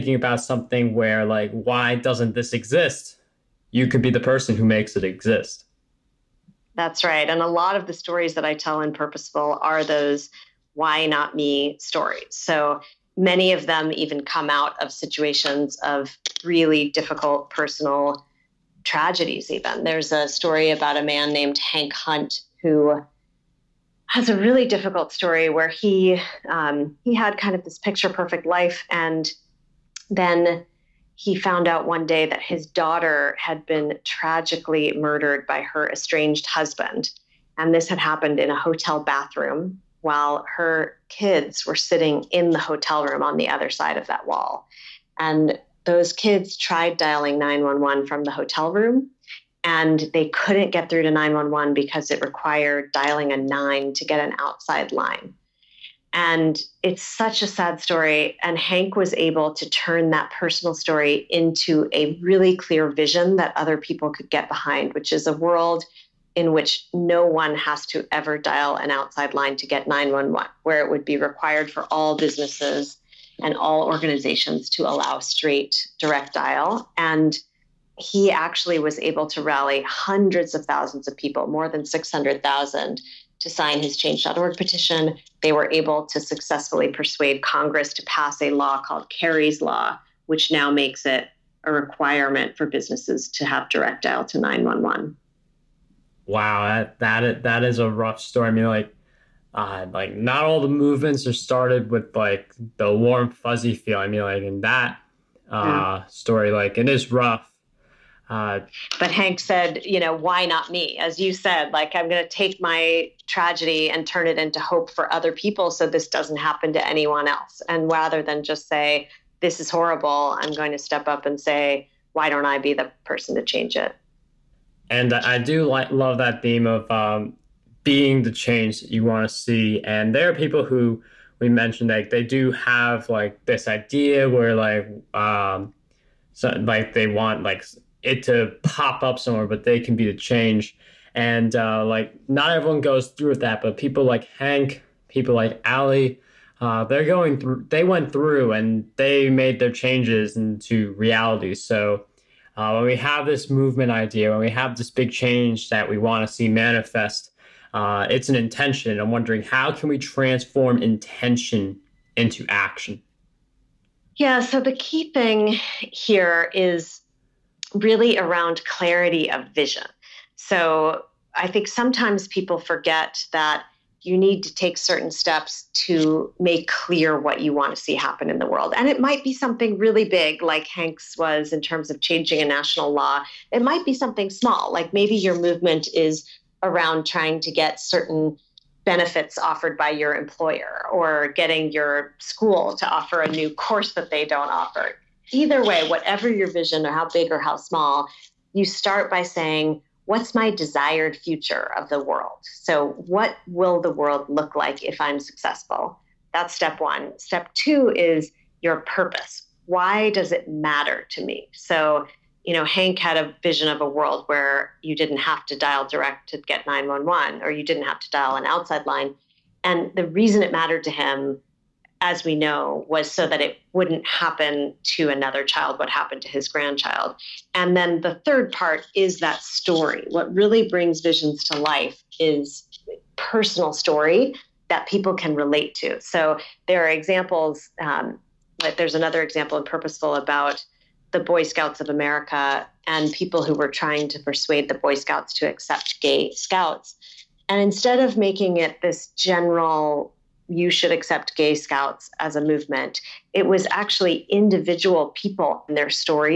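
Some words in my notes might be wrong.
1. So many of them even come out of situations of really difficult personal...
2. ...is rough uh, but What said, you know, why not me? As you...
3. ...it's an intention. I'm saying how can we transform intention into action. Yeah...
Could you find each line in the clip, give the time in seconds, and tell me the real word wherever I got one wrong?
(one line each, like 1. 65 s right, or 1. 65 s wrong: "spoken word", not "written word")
1. 12 s right
2. 106 s wrong: "Hank", not "What"
3. 158 s wrong: "wondering", not "saying".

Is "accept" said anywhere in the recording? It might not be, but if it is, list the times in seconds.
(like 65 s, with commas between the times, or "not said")
245 s, 250 s.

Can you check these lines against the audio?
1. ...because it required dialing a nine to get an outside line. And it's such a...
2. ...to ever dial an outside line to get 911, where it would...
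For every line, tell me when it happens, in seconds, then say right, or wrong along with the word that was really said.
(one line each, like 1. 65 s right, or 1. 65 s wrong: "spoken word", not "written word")
1. 51 s right
2. 67 s right.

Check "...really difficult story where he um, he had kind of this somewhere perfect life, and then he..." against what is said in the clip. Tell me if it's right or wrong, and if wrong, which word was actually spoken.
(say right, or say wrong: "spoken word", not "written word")
wrong: "picture", not "somewhere".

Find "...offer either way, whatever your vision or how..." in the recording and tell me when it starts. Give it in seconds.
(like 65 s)
194 s.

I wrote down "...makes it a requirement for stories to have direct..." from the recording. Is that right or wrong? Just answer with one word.
wrong.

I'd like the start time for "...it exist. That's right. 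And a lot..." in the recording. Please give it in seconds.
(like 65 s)
4 s.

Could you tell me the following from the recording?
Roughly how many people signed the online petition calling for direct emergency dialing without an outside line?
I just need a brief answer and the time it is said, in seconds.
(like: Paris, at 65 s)
more than 600,000, at 81 s.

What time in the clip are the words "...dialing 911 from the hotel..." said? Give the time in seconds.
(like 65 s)
46 s.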